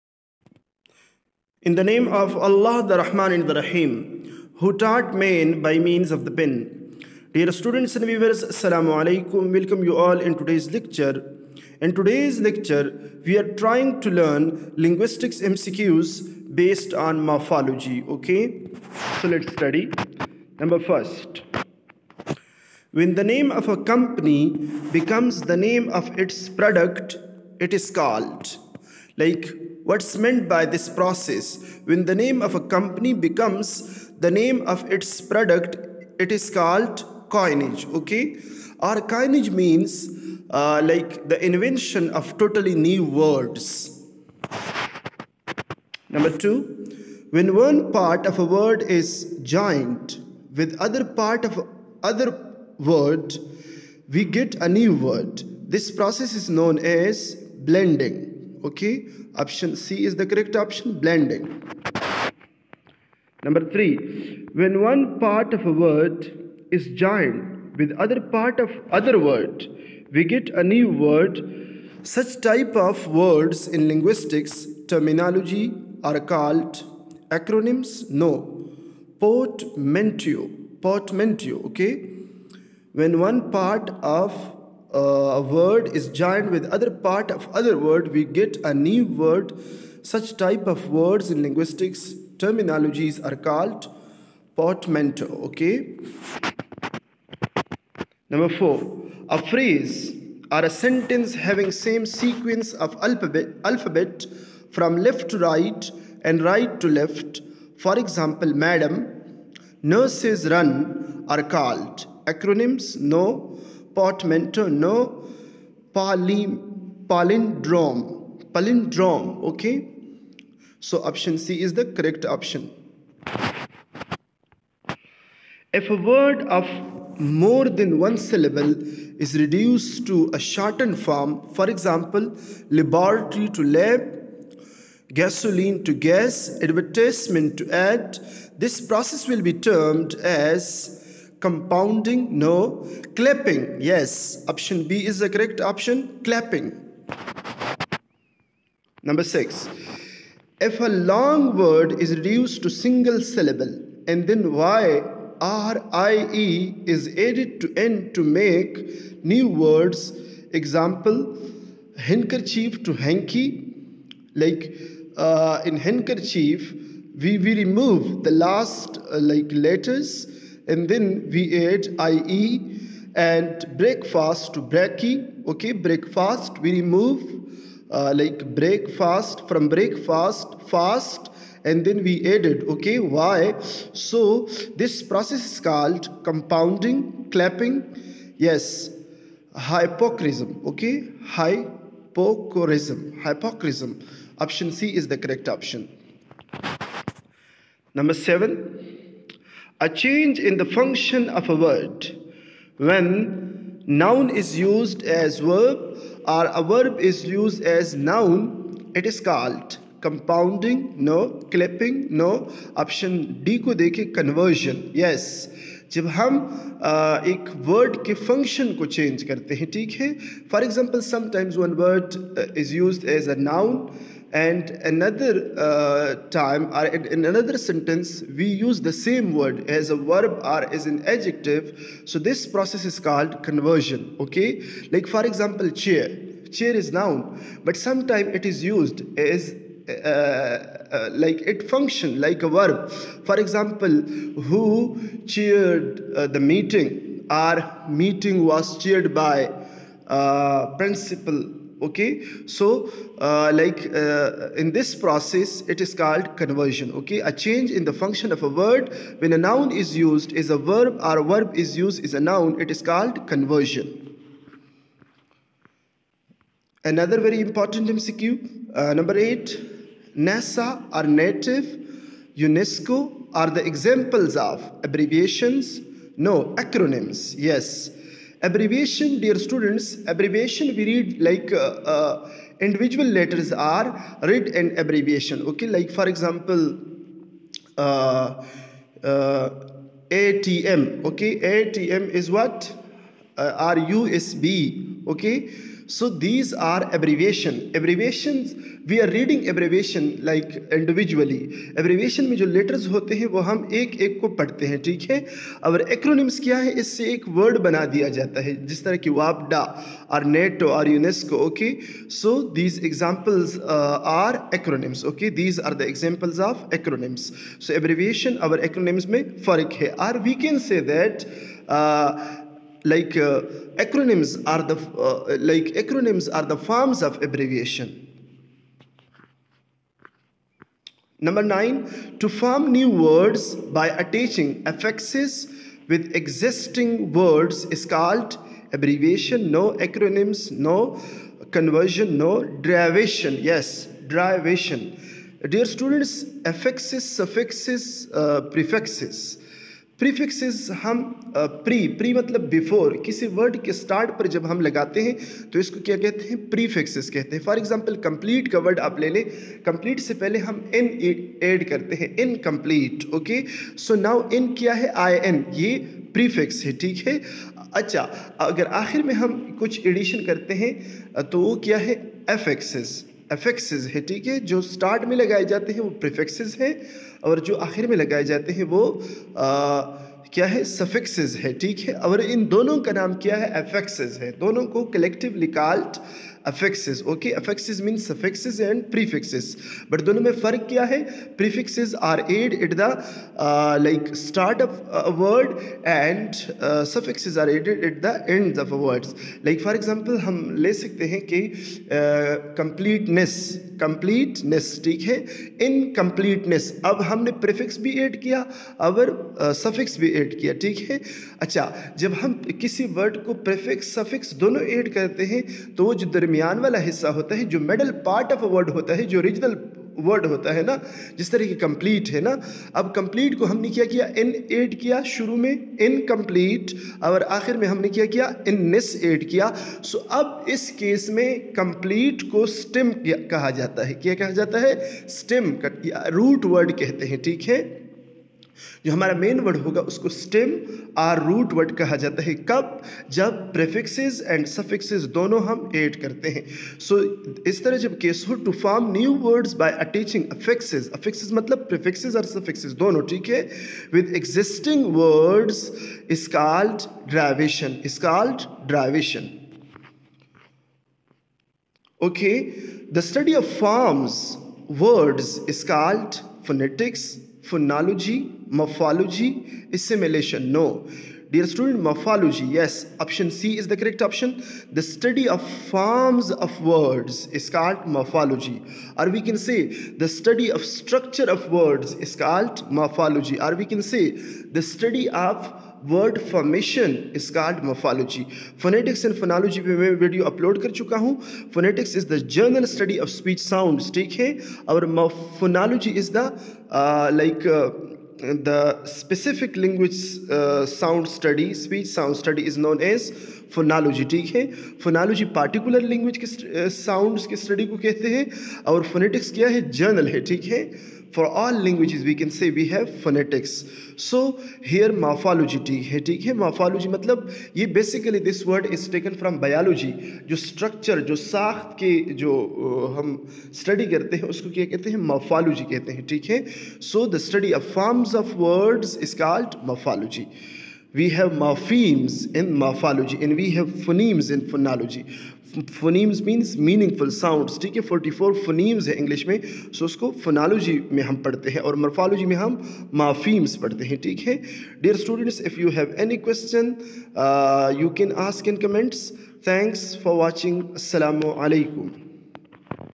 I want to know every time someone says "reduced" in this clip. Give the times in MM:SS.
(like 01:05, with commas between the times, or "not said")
02:09, 02:32.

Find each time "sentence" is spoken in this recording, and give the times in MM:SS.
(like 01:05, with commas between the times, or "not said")
01:40, 03:47.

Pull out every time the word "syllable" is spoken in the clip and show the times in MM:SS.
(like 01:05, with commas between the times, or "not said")
02:08, 02:33.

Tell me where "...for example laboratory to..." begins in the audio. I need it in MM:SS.
02:11.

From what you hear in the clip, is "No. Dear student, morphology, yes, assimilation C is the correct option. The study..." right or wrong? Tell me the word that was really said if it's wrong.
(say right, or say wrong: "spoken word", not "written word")
wrong: "option", not "assimilation".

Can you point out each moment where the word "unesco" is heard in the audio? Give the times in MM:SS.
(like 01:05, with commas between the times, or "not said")
04:32, 05:10.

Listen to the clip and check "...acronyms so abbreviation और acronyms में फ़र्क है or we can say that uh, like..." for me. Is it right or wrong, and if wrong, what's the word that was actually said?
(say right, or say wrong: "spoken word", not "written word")
right.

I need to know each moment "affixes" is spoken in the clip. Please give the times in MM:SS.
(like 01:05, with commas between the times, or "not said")
05:34, 05:46.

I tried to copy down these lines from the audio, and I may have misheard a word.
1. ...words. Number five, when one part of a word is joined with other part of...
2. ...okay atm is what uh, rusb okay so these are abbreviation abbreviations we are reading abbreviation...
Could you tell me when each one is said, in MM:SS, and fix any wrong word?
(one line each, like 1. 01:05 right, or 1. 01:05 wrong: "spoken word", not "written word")
1. 00:43 wrong: "two", not "five"
2. 04:51 right.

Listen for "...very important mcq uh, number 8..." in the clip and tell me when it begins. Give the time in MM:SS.
04:27.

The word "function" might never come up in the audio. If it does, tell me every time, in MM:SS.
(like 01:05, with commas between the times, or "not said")
03:20, 04:01, 04:17.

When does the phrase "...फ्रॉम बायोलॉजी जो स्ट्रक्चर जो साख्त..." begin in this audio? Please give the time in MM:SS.
08:39.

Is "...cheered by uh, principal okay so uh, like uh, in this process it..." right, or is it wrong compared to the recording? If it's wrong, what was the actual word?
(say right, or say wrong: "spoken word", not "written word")
right.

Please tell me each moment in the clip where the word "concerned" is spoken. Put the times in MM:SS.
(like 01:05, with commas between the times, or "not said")
not said.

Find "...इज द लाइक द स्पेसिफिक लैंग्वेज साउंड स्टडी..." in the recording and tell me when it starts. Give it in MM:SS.
08:16.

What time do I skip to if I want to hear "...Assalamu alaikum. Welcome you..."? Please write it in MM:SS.
00:08.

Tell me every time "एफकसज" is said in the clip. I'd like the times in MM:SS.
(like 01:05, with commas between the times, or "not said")
06:13, 06:23.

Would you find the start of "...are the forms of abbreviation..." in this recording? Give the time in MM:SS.
05:26.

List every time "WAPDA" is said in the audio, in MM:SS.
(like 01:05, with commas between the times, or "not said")
05:09.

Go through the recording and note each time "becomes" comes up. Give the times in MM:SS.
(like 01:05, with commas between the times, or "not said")
00:24, 00:33.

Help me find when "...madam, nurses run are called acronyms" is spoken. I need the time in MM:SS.
01:48.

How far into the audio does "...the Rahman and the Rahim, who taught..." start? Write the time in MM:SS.
00:02.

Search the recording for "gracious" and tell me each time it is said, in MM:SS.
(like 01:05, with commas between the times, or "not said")
not said.